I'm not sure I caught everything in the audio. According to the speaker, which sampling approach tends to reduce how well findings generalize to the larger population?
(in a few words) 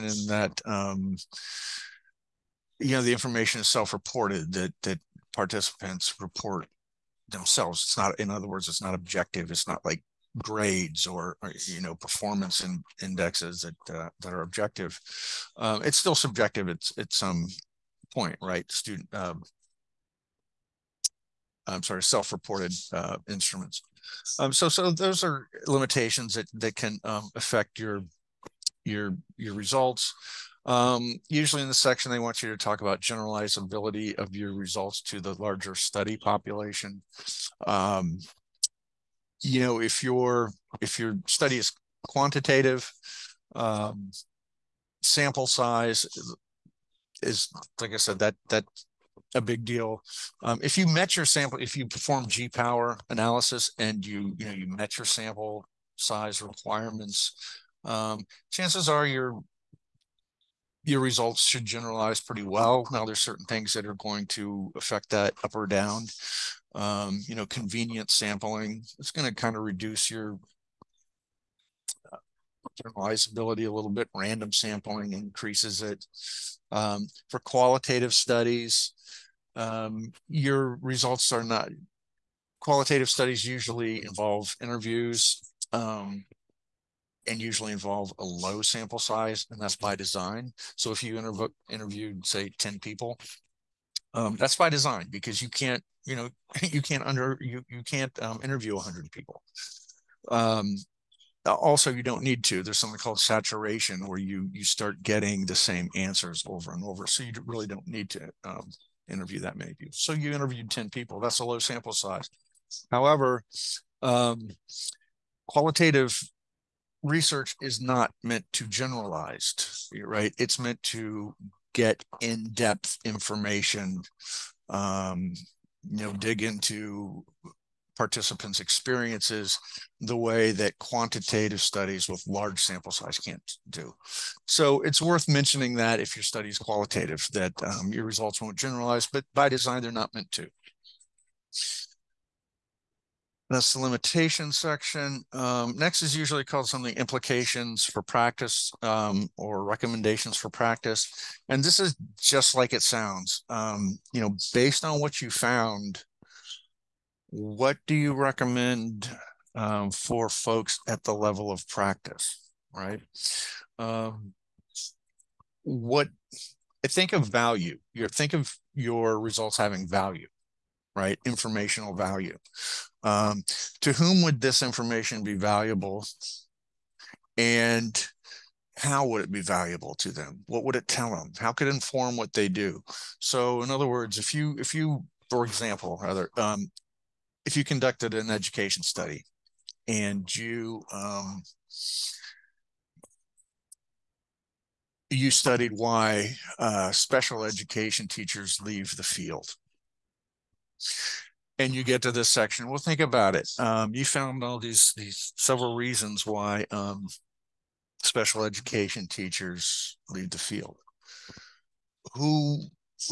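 convenient sampling.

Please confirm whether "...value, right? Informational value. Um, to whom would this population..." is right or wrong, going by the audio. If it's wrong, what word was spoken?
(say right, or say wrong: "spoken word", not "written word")
wrong: "information", not "population".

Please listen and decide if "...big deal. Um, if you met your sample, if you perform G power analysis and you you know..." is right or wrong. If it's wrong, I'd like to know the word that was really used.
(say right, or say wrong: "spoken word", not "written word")
right.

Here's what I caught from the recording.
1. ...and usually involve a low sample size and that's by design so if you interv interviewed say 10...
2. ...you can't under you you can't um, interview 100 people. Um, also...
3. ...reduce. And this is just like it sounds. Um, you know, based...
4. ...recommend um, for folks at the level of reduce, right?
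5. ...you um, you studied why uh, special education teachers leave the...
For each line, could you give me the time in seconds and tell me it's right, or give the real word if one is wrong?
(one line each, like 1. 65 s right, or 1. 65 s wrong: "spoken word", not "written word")
1. 87 s right
2. 96 s right
3. 150 s wrong: "practice", not "reduce"
4. 158 s wrong: "practice", not "reduce"
5. 190 s right.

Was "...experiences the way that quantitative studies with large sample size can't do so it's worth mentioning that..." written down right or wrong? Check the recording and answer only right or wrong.
right.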